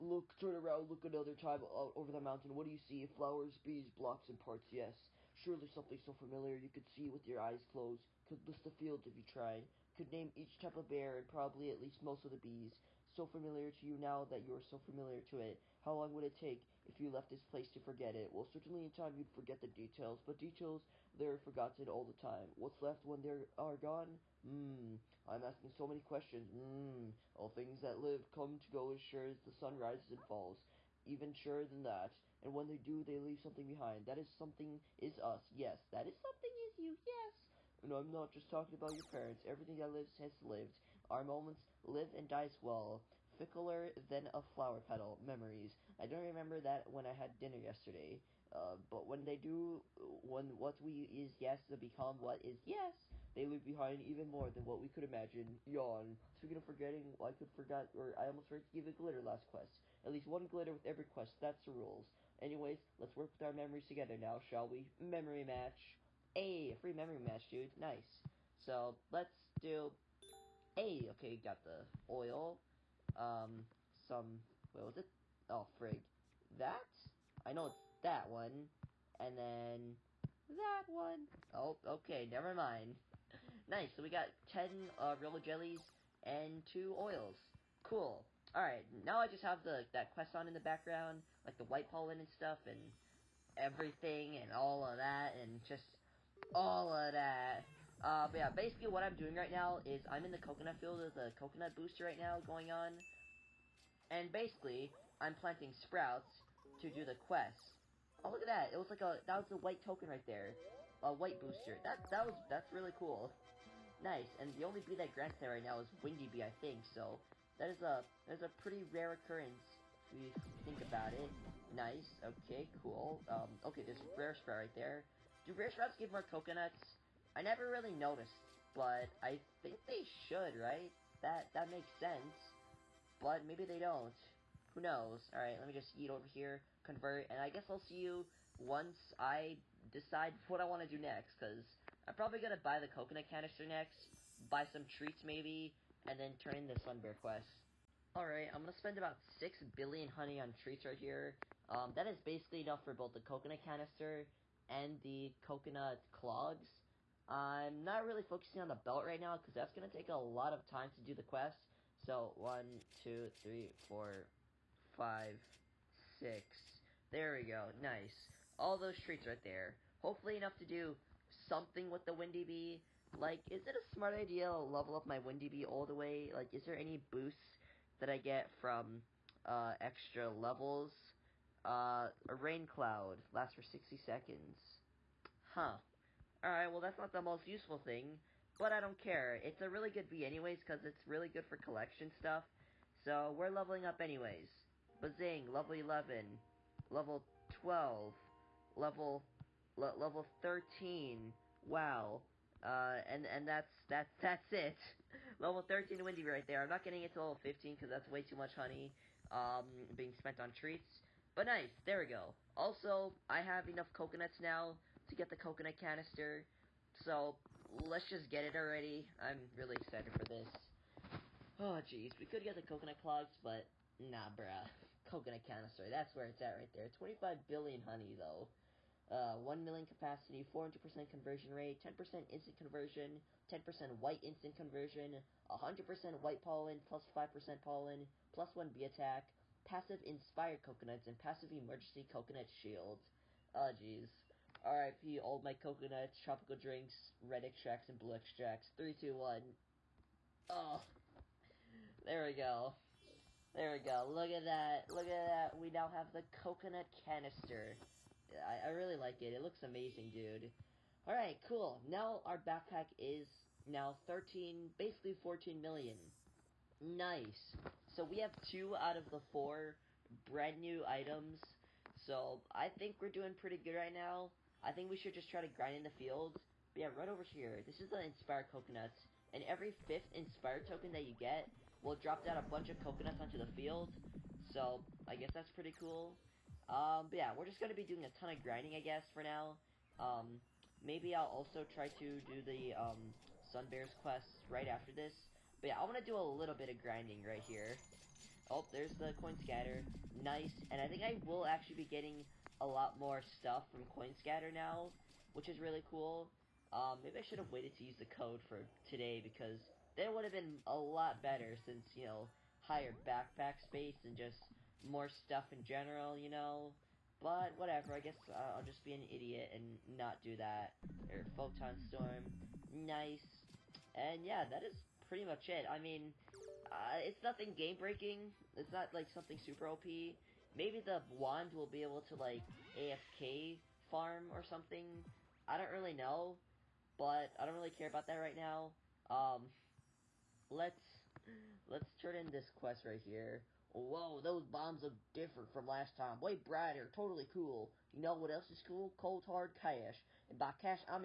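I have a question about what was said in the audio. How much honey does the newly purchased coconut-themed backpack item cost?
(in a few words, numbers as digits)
25 billion honey.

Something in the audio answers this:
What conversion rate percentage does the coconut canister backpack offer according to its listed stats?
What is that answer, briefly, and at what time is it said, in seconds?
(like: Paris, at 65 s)
400%, at 230 s.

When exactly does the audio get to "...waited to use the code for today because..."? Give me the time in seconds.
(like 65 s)
307 s.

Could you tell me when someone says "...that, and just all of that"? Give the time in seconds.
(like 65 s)
94 s.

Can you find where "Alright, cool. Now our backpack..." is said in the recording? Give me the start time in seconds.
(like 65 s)
261 s.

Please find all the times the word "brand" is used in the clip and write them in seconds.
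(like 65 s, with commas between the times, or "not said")
270 s.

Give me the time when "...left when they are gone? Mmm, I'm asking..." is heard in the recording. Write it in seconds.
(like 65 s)
22 s.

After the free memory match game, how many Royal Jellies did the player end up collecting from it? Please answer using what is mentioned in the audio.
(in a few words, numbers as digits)
10.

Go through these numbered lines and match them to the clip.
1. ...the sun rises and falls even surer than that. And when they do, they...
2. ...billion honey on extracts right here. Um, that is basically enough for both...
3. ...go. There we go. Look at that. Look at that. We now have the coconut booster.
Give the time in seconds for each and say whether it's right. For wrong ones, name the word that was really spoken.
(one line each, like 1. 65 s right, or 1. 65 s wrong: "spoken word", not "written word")
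1. 29 s right
2. 149 s wrong: "treats", not "extracts"
3. 252 s wrong: "canister", not "booster".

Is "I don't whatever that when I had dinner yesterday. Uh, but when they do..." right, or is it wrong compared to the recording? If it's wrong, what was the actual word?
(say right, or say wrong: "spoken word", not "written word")
wrong: "remember", not "whatever".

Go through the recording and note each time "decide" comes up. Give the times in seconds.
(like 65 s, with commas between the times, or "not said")
139 s.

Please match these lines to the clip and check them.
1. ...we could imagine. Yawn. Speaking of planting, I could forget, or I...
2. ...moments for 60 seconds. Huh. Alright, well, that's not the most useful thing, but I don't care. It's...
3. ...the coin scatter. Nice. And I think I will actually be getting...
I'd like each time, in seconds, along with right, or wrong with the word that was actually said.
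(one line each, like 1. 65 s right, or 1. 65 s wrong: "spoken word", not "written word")
1. 54 s wrong: "forgetting", not "planting"
2. 183 s wrong: "lasts", not "moments"
3. 298 s right.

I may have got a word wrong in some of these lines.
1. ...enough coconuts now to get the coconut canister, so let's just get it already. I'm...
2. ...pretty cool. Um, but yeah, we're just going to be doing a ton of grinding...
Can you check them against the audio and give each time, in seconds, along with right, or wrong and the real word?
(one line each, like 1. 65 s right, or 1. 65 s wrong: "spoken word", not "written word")
1. 213 s right
2. 285 s right.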